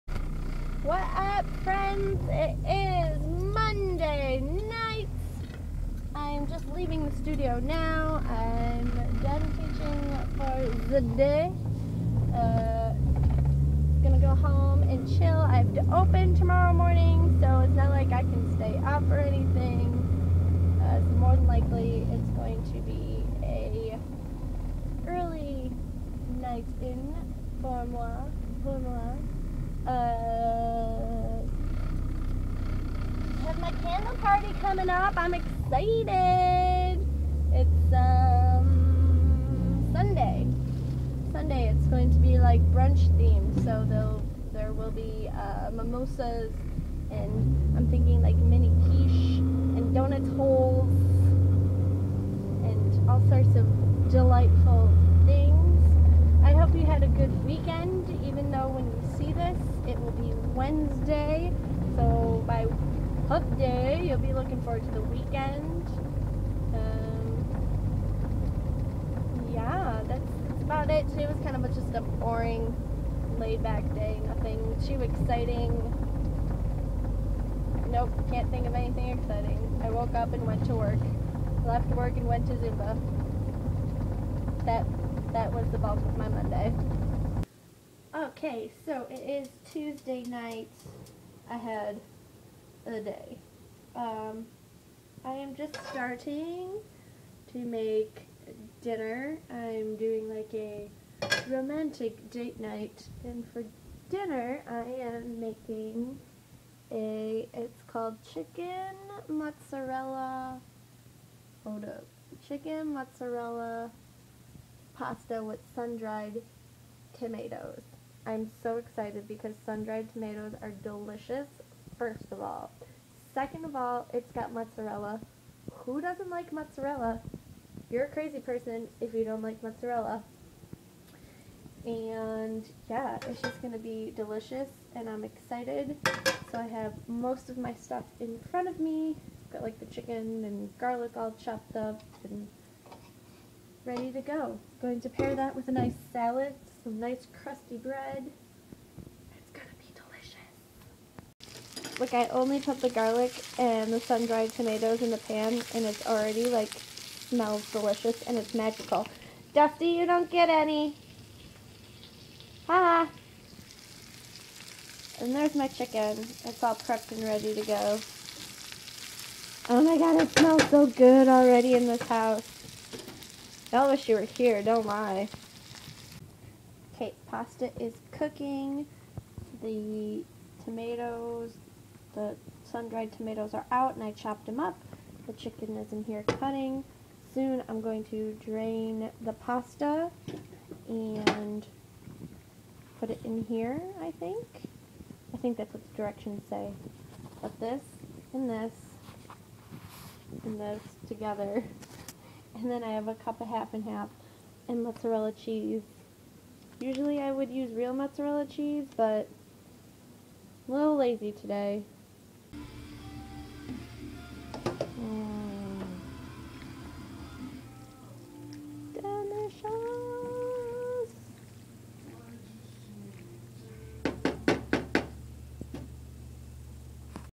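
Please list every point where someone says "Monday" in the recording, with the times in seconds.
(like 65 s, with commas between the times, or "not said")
3 s, 86 s.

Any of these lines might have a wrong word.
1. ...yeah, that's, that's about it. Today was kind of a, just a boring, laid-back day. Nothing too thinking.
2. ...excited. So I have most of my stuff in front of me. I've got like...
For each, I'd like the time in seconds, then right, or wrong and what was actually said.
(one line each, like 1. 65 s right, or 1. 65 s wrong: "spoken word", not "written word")
1. 69 s wrong: "exciting", not "thinking"
2. 135 s right.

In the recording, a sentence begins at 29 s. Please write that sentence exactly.
Uh, have my candle party coming up.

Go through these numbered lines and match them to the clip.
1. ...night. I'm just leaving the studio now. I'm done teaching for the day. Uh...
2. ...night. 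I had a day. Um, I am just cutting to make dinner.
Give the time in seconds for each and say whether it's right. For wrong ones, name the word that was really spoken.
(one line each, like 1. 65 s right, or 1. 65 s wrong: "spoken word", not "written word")
1. 4 s right
2. 90 s wrong: "starting", not "cutting".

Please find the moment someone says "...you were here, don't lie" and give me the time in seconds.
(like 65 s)
174 s.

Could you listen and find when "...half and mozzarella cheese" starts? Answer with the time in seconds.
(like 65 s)
203 s.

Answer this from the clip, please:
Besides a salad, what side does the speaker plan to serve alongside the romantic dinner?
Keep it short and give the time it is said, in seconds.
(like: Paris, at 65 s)
Crusty bread, at 147 s.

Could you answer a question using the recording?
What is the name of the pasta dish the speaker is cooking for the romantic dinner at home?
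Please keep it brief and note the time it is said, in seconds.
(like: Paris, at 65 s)
Chicken mozzarella pasta, at 112 s.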